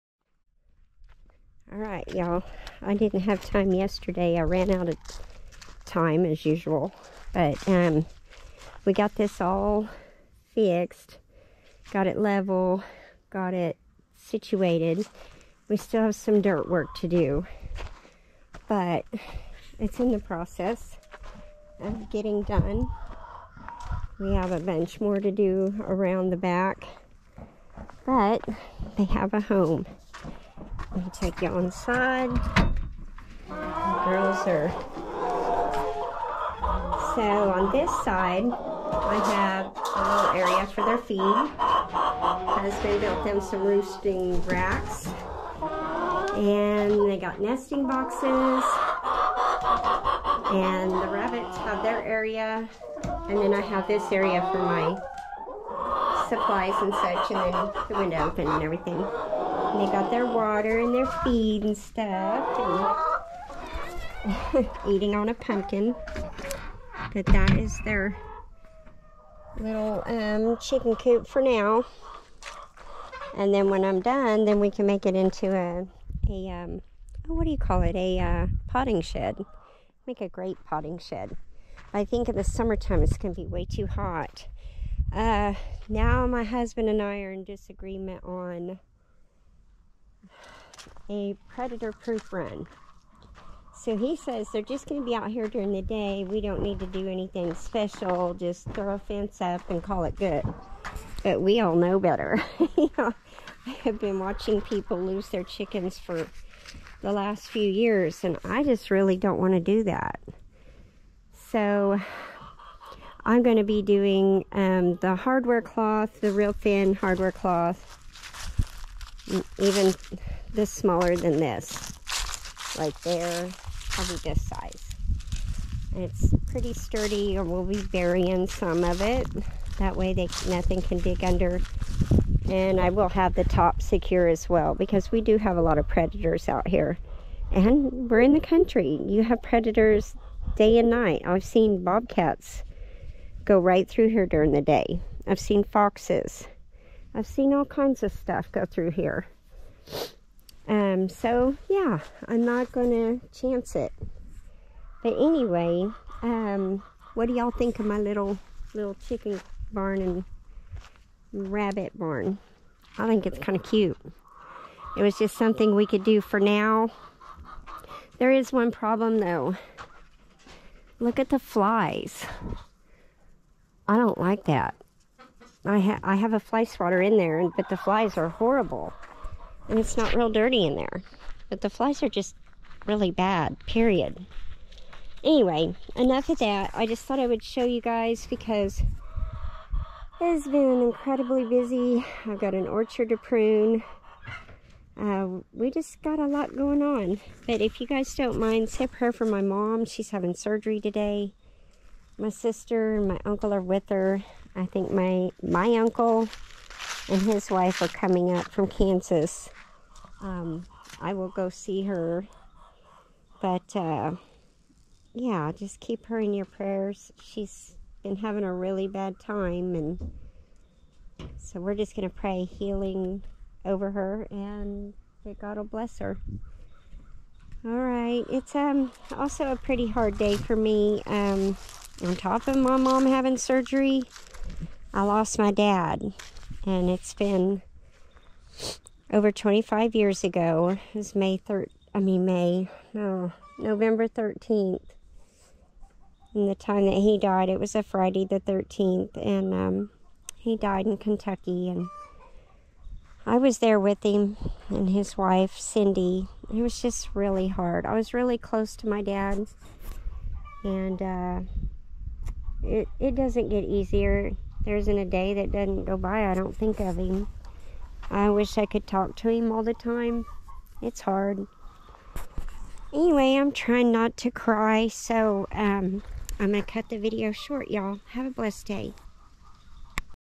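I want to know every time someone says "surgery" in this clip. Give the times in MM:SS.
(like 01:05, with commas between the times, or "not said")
03:20, 03:53.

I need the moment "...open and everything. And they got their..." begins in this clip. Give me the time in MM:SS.
00:58.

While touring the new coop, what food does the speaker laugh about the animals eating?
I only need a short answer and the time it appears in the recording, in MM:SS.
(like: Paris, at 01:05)
pumpkin, at 01:05.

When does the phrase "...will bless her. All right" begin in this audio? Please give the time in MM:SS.
03:45.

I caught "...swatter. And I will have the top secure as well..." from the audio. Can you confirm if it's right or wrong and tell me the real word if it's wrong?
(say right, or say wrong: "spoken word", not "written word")
wrong: "under", not "swatter".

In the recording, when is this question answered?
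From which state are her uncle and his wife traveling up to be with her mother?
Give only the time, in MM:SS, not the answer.
03:28.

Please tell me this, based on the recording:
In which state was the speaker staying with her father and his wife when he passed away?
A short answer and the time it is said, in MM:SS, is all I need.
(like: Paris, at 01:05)
Kentucky, at 04:10.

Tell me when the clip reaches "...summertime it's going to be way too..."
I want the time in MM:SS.
01:22.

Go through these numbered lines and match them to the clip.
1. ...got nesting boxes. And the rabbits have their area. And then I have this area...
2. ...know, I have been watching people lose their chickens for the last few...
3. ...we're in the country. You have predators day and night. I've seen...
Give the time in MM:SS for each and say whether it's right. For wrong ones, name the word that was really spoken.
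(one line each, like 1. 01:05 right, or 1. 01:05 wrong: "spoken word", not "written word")
1. 00:47 right
2. 01:42 right
3. 02:18 right.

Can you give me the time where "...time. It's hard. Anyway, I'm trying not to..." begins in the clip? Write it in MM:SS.
04:29.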